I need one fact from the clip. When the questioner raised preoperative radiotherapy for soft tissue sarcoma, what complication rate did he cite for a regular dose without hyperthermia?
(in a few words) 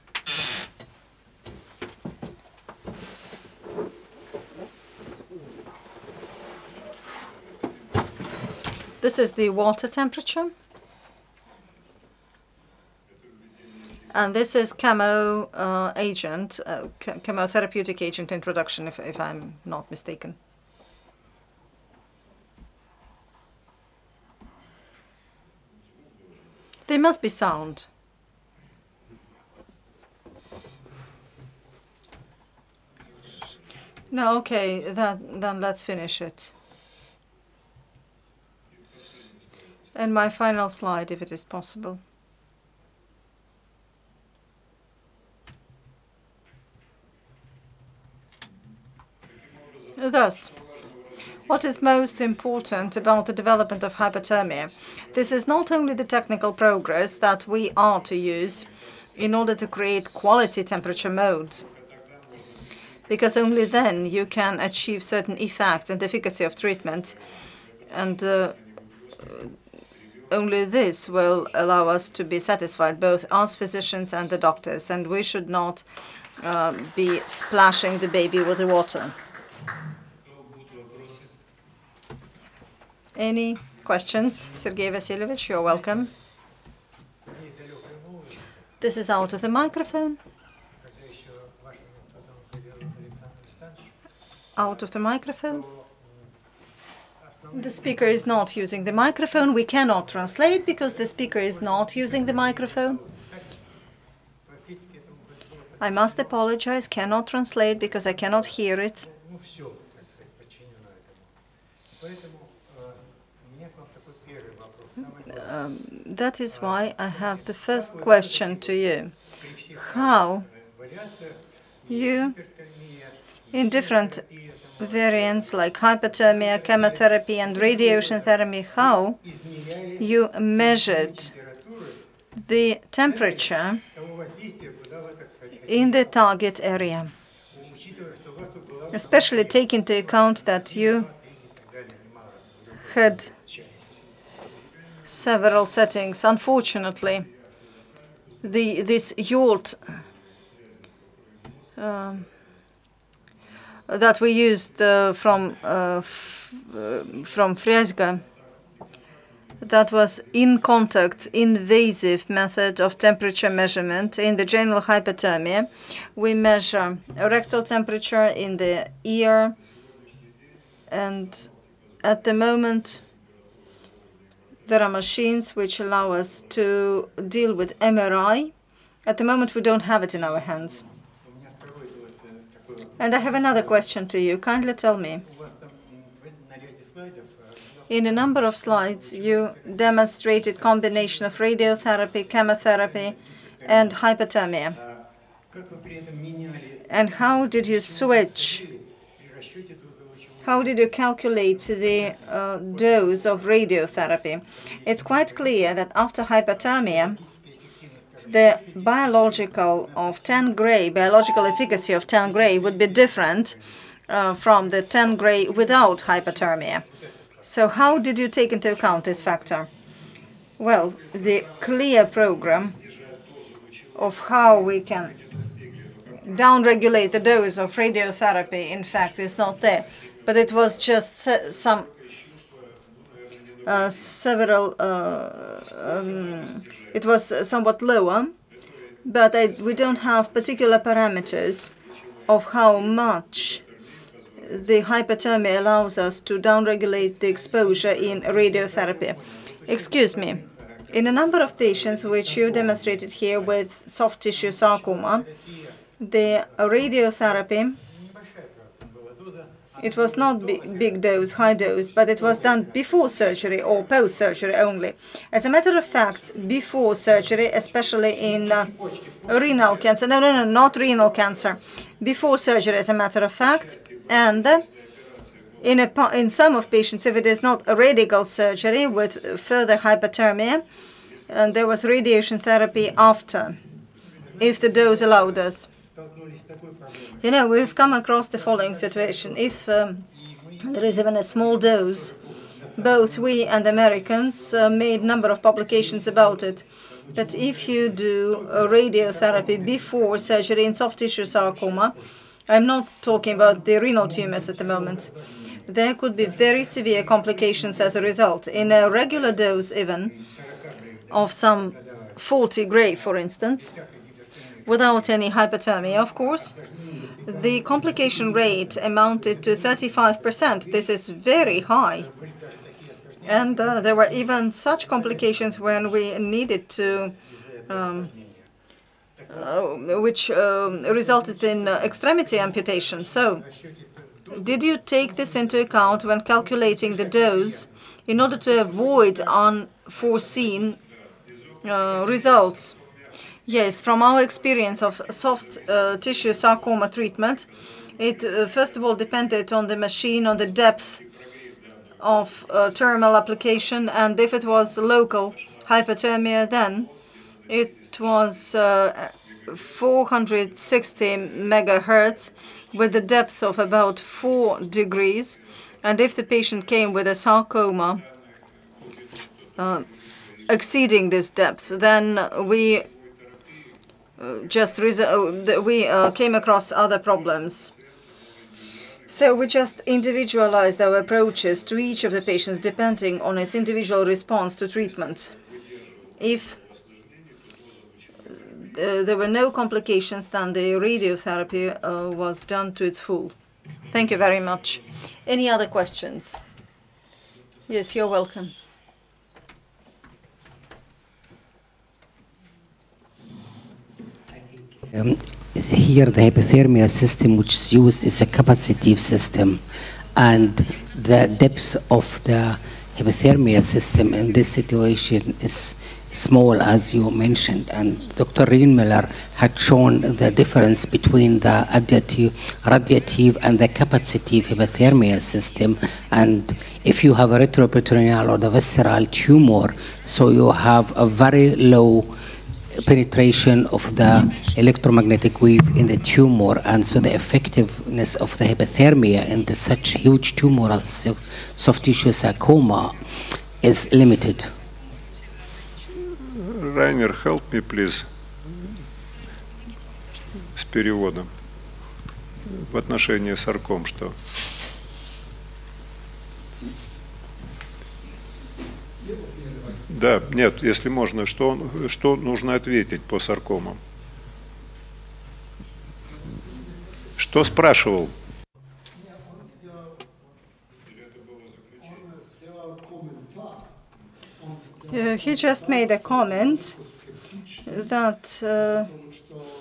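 35%.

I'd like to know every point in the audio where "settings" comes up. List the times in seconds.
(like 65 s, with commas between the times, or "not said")
145 s.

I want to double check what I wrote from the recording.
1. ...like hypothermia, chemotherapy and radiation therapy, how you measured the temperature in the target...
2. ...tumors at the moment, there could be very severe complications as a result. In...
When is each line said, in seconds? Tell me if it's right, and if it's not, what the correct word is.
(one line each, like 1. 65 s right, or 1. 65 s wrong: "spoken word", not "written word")
1. 125 s right
2. 304 s right.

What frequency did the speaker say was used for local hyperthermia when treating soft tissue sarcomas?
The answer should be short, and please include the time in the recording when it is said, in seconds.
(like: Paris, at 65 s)
460 megahertz, at 359 s.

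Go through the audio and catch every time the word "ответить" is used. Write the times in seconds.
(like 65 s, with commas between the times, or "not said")
462 s.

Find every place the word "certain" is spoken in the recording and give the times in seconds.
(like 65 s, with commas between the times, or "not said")
65 s.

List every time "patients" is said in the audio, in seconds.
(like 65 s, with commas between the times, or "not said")
251 s, 276 s, 366 s, 382 s.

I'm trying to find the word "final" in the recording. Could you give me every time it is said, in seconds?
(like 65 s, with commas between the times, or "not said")
40 s.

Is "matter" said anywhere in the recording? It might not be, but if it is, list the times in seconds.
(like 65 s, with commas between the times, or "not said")
265 s, 272 s.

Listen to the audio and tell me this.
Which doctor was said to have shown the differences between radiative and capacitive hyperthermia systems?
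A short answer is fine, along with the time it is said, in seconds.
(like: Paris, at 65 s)
Dr. Rienmiller, at 418 s.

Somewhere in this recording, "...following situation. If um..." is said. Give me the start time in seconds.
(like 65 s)
288 s.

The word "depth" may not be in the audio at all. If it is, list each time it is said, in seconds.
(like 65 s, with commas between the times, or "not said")
350 s, 363 s, 371 s, 411 s.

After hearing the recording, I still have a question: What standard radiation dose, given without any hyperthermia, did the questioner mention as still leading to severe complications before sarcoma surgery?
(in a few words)
40 gray.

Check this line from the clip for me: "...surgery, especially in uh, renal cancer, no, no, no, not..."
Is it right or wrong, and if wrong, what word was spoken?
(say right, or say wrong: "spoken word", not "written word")
right.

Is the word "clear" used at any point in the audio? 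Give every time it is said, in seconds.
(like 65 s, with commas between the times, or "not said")
205 s, 221 s.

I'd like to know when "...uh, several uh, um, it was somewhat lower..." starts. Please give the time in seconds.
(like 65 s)
233 s.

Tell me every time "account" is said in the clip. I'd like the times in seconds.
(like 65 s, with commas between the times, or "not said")
139 s, 218 s, 335 s.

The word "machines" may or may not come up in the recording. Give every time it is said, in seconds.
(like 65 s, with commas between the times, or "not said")
174 s, 349 s.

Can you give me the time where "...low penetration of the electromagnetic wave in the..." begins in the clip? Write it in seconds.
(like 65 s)
431 s.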